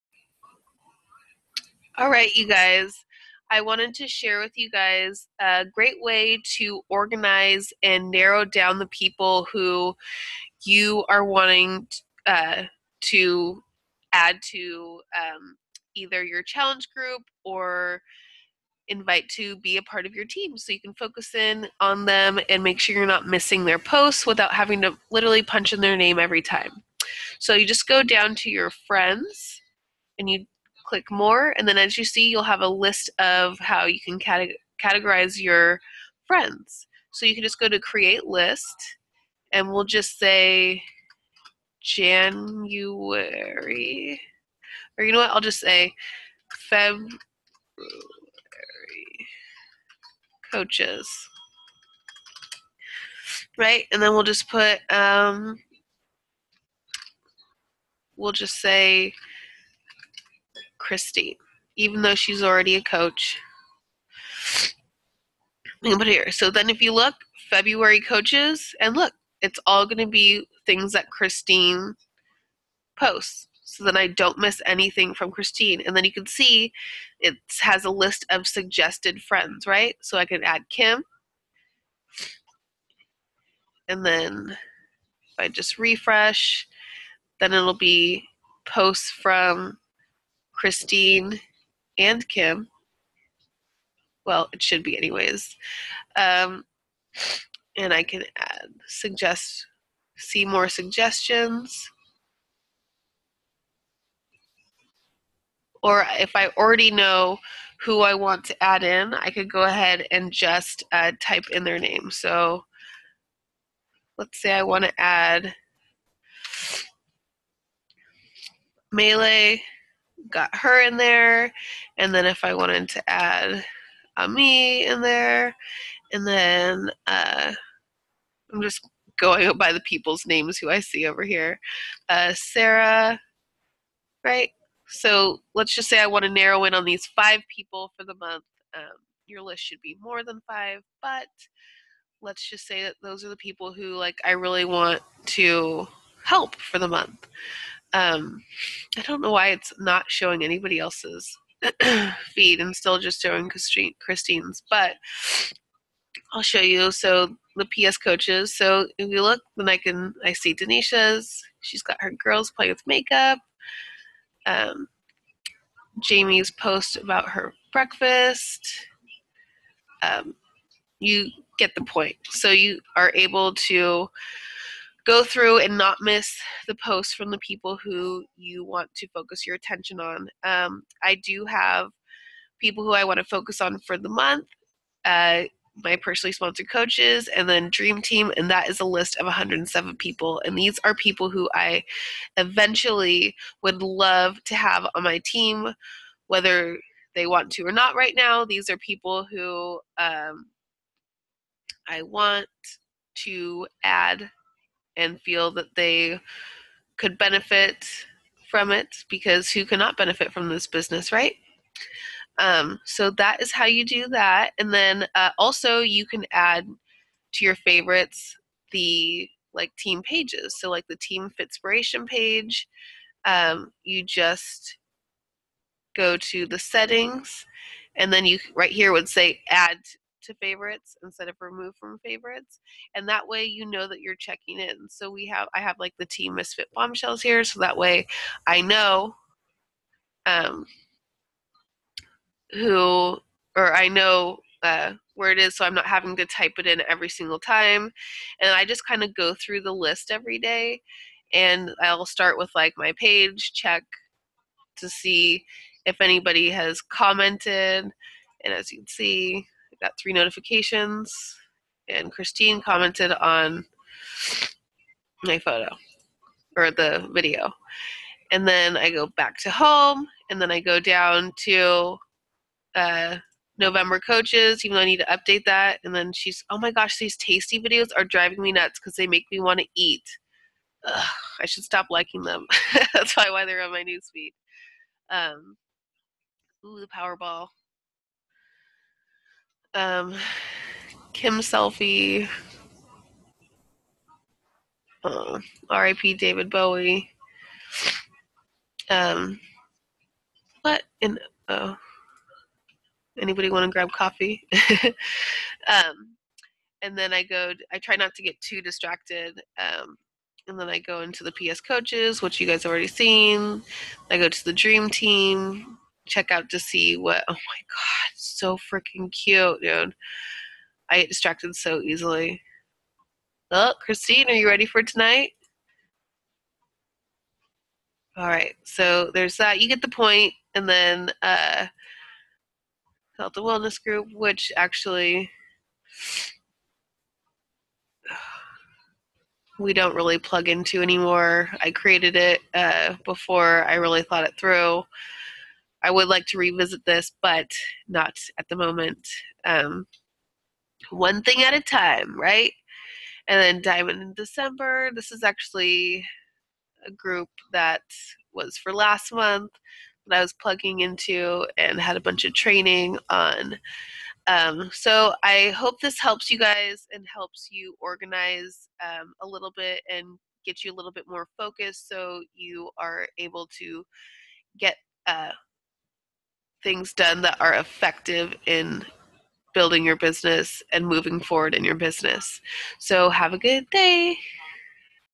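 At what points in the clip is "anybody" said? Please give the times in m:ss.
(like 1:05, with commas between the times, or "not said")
2:30, 4:15, 5:03.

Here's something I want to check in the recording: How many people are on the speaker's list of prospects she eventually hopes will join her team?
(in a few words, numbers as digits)
107.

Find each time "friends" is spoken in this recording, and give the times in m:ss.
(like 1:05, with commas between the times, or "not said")
0:28, 0:36, 1:19.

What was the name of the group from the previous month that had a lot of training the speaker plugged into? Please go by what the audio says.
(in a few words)
Diamond in December.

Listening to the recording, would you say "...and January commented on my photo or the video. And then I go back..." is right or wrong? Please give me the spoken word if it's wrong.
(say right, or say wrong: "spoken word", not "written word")
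wrong: "Christine", not "January".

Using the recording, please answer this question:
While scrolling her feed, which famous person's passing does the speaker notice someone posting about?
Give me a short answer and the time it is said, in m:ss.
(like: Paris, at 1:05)
David Bowie, at 4:56.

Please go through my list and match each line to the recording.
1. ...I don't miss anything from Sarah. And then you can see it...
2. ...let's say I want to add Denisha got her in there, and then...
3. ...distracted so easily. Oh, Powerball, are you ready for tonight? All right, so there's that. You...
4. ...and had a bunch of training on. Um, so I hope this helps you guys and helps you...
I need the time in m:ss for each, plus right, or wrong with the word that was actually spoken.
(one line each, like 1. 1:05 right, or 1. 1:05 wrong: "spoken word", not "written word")
1. 1:13 wrong: "Christine", not "Sarah"
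2. 1:54 wrong: "Melee", not "Denisha"
3. 5:21 wrong: "Christine", not "Powerball"
4. 6:01 right.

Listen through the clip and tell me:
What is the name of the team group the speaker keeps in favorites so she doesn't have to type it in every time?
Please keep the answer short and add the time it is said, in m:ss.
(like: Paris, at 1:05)
team misfit bombshells, at 3:56.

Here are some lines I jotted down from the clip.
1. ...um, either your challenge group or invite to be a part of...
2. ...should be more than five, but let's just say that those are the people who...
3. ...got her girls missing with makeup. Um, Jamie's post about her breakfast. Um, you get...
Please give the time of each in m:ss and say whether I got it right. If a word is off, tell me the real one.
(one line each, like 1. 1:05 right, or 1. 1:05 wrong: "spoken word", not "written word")
1. 0:15 right
2. 2:19 right
3. 2:41 wrong: "playing", not "missing".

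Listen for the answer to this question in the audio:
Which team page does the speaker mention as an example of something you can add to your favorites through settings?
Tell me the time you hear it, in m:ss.
3:41.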